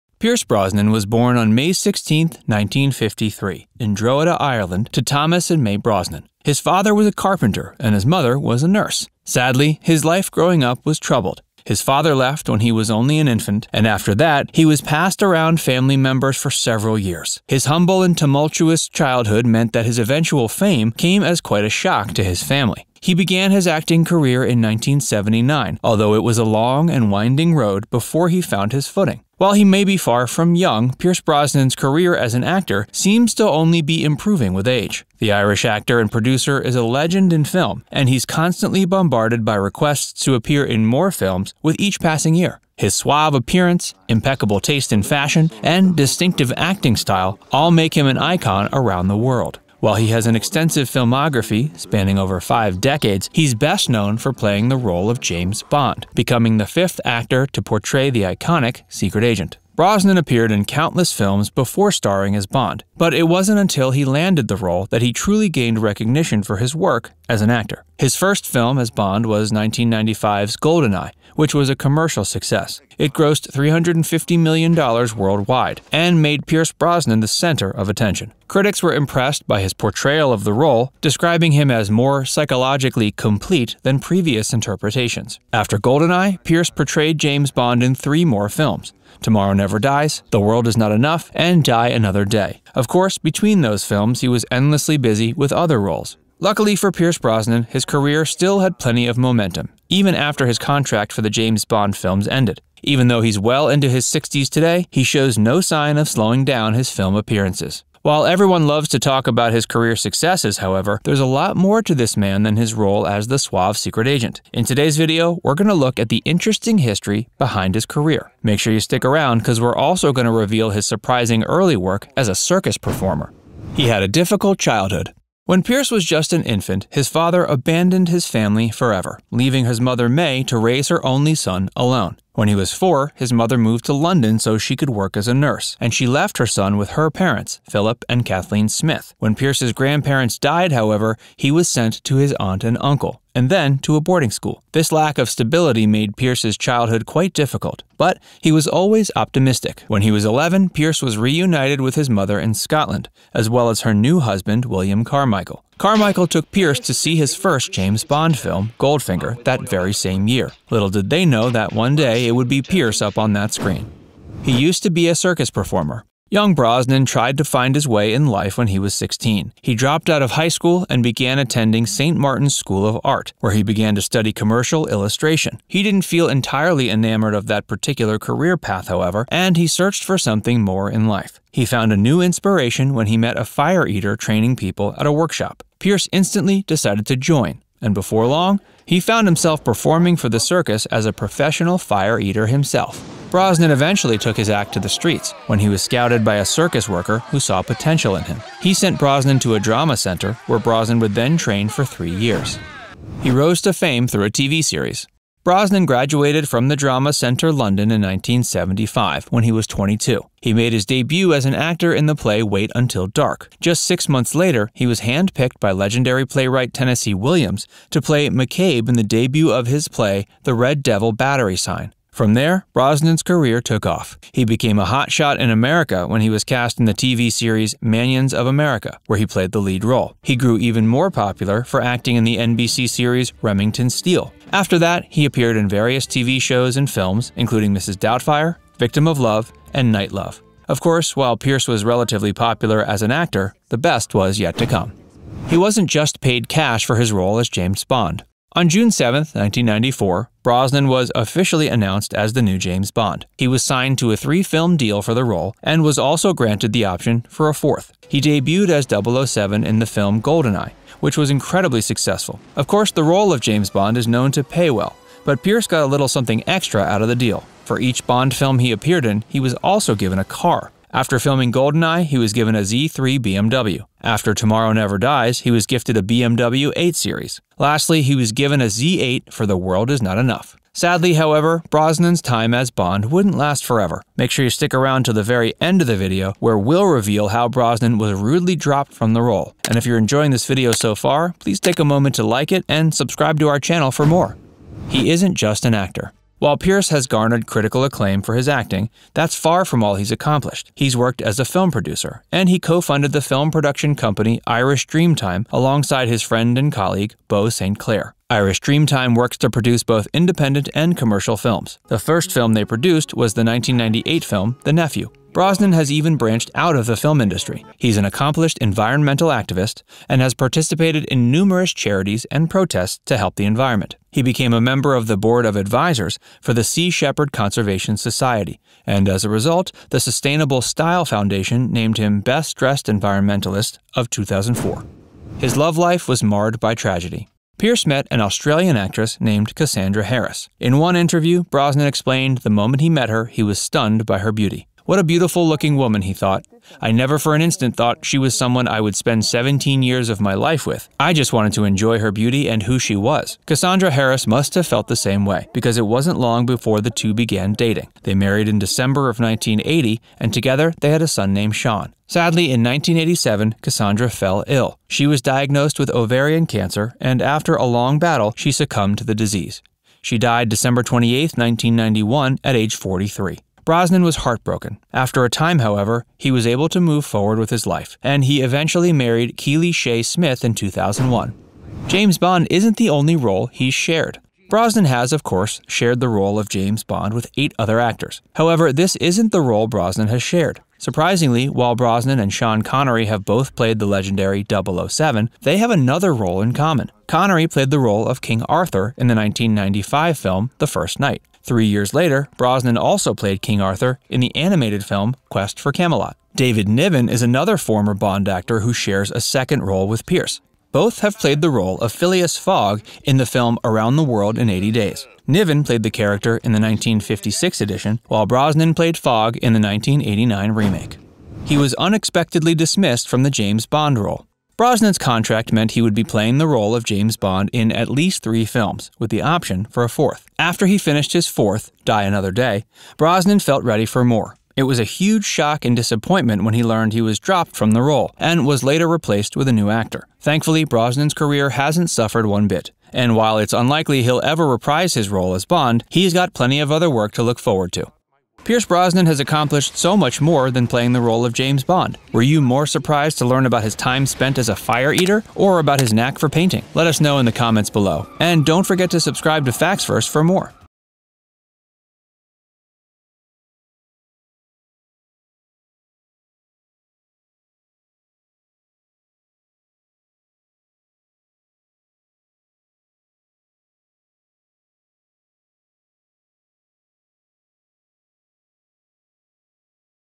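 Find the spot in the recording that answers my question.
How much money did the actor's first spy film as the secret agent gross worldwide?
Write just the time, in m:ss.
1:13.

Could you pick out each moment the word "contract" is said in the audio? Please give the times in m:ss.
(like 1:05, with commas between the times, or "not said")
1:40, 7:04.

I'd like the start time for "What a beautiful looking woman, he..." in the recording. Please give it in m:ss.
5:44.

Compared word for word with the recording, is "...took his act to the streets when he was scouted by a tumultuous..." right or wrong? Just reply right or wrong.
wrong.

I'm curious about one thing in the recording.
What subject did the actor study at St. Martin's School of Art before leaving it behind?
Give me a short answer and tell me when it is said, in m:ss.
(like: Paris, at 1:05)
Commercial illustration, at 2:54.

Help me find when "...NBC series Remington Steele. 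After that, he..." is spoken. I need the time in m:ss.
3:52.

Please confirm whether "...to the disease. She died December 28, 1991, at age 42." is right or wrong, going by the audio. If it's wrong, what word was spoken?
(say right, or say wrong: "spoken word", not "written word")
wrong: "43", not "42".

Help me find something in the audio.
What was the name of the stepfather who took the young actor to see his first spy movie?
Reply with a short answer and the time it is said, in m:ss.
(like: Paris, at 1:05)
William Carmichael, at 2:34.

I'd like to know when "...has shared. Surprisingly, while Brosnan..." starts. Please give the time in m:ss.
6:30.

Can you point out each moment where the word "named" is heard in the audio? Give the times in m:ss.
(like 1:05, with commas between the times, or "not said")
5:31, 5:39, 6:01.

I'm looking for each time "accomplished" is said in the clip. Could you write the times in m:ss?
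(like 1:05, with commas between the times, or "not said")
5:00, 5:18, 7:29.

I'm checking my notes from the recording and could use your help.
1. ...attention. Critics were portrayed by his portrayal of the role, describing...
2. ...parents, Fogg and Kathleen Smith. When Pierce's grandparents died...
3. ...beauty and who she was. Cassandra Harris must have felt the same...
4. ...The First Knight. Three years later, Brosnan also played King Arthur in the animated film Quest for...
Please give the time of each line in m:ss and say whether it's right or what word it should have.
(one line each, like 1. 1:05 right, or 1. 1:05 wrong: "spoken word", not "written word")
1. 1:17 wrong: "impressed", not "portrayed"
2. 2:17 wrong: "Philip", not "Fogg"
3. 5:52 right
4. 6:40 right.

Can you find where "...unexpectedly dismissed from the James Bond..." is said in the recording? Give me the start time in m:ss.
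7:01.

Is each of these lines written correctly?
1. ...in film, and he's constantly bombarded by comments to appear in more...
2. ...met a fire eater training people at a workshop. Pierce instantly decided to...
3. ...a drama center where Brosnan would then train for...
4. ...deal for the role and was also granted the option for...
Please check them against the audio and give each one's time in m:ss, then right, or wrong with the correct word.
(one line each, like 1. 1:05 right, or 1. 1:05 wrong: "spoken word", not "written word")
1. 0:37 wrong: "requests", not "comments"
2. 3:03 right
3. 3:19 right
4. 4:14 right.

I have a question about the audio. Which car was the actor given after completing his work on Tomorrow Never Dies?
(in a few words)
BMW 8 Series.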